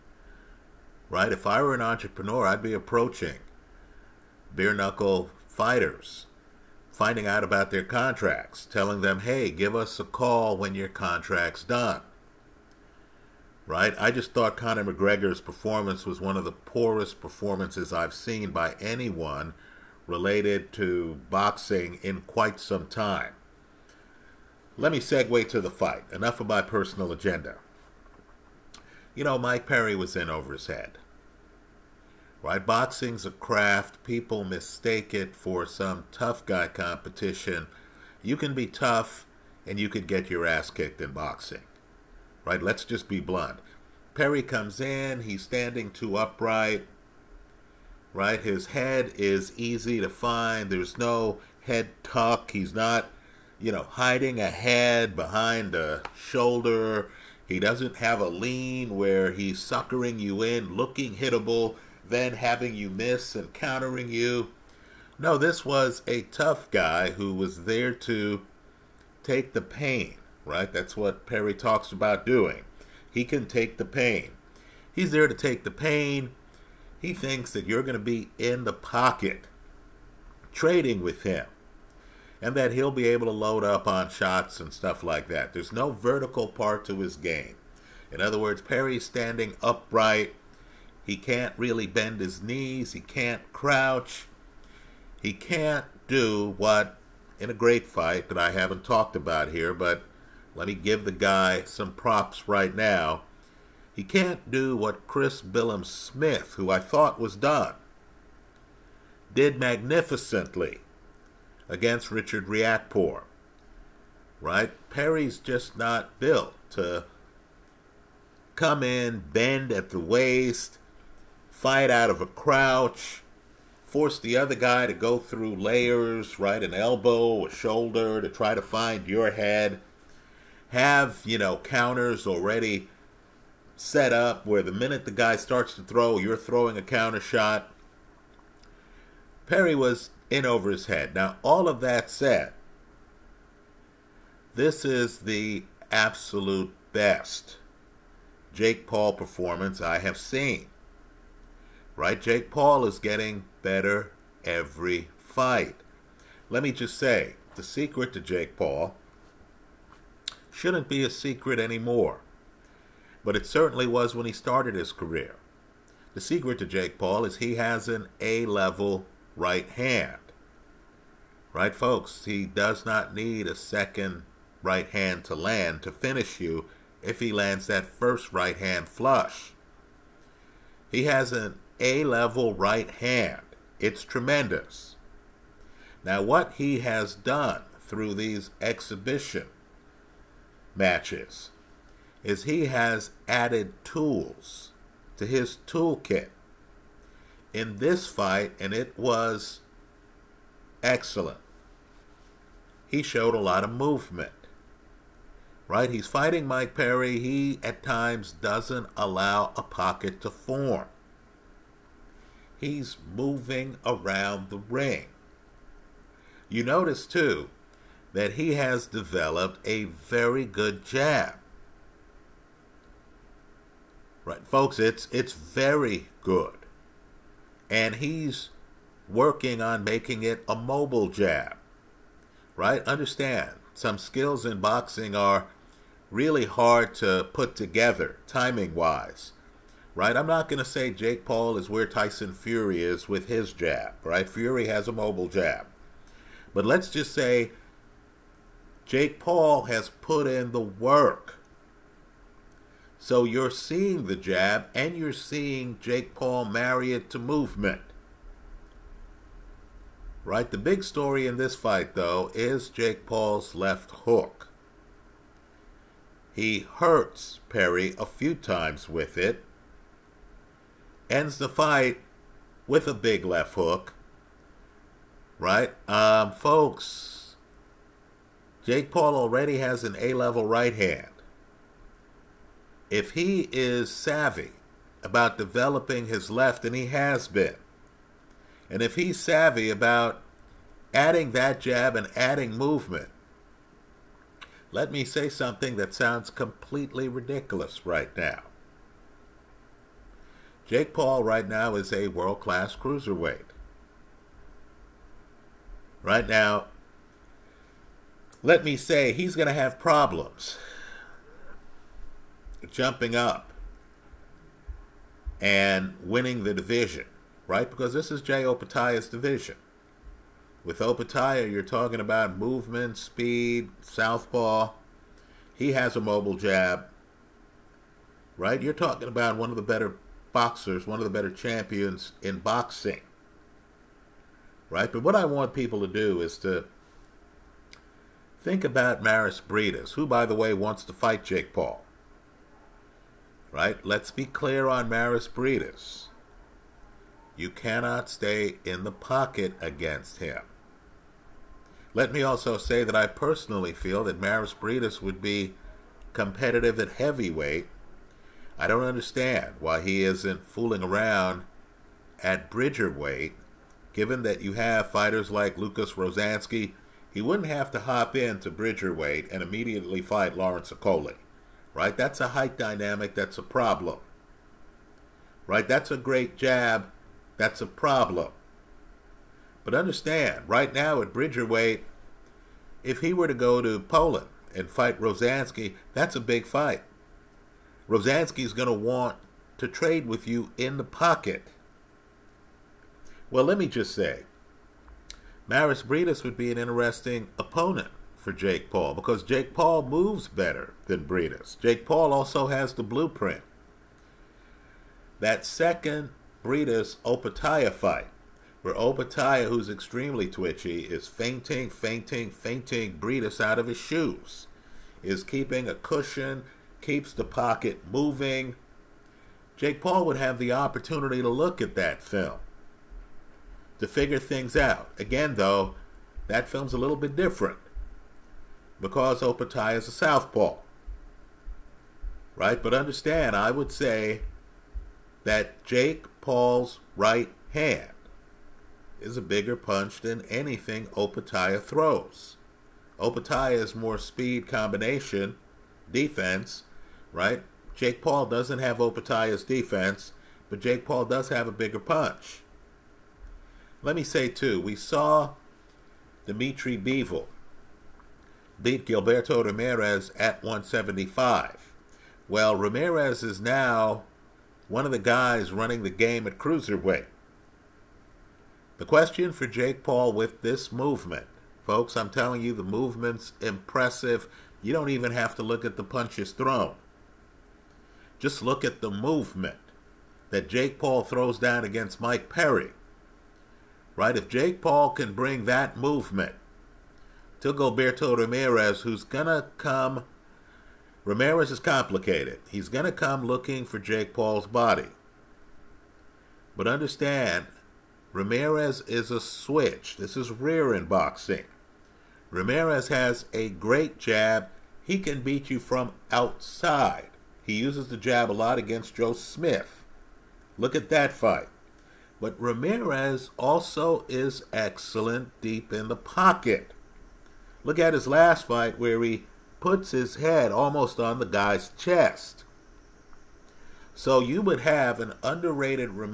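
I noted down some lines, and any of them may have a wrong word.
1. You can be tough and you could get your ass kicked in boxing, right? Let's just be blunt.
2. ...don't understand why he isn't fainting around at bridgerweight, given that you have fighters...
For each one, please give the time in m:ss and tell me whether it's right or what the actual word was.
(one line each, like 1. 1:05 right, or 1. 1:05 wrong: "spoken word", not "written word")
1. 0:38 right
2. 5:58 wrong: "fooling", not "fainting".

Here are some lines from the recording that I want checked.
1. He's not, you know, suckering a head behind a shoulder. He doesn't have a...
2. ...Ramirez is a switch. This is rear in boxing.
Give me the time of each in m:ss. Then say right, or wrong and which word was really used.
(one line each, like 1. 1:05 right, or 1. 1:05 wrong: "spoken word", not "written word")
1. 0:52 wrong: "hiding", not "suckering"
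2. 8:18 right.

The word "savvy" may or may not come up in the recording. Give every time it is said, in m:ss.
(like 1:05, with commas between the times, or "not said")
4:43, 4:49.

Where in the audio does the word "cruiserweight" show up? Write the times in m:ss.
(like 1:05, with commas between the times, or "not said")
5:02, 7:46.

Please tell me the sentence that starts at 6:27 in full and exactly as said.
Rozanski is going to want to trade with you in the pocket.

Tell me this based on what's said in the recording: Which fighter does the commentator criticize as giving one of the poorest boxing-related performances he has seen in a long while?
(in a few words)
Conor McGregor.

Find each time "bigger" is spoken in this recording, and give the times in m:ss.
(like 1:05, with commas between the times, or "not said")
7:19, 7:31.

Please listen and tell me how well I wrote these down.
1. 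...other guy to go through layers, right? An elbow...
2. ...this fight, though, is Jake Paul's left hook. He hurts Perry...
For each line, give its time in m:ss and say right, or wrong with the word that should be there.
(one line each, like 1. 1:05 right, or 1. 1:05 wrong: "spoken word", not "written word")
1. 2:04 right
2. 4:21 right.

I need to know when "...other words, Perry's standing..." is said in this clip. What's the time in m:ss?
1:28.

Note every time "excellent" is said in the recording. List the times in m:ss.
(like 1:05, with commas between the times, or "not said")
3:20, 8:34.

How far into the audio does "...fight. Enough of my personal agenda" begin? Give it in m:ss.
0:25.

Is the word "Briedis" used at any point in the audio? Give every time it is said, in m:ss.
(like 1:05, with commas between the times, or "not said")
5:39, 5:45, 5:54, 6:35, 6:41, 6:46, 6:52.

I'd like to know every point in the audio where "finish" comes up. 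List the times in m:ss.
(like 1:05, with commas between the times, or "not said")
2:55.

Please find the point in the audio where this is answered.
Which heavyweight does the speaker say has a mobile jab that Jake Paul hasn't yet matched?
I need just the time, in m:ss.
4:01.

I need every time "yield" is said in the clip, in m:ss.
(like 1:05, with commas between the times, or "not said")
not said.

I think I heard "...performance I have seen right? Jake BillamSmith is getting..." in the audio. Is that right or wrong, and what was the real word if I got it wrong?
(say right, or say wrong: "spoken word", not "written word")
wrong: "Paul", not "BillamSmith".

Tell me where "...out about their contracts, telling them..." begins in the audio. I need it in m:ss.
0:07.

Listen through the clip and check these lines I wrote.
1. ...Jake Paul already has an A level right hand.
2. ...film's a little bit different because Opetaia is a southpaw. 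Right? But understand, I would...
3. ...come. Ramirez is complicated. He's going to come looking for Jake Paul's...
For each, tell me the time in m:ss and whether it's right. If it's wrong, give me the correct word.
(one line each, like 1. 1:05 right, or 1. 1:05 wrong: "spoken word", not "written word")
1. 4:38 right
2. 7:06 right
3. 8:09 right.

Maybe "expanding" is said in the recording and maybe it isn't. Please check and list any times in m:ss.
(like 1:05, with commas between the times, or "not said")
not said.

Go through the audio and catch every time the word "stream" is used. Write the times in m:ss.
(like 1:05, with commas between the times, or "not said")
not said.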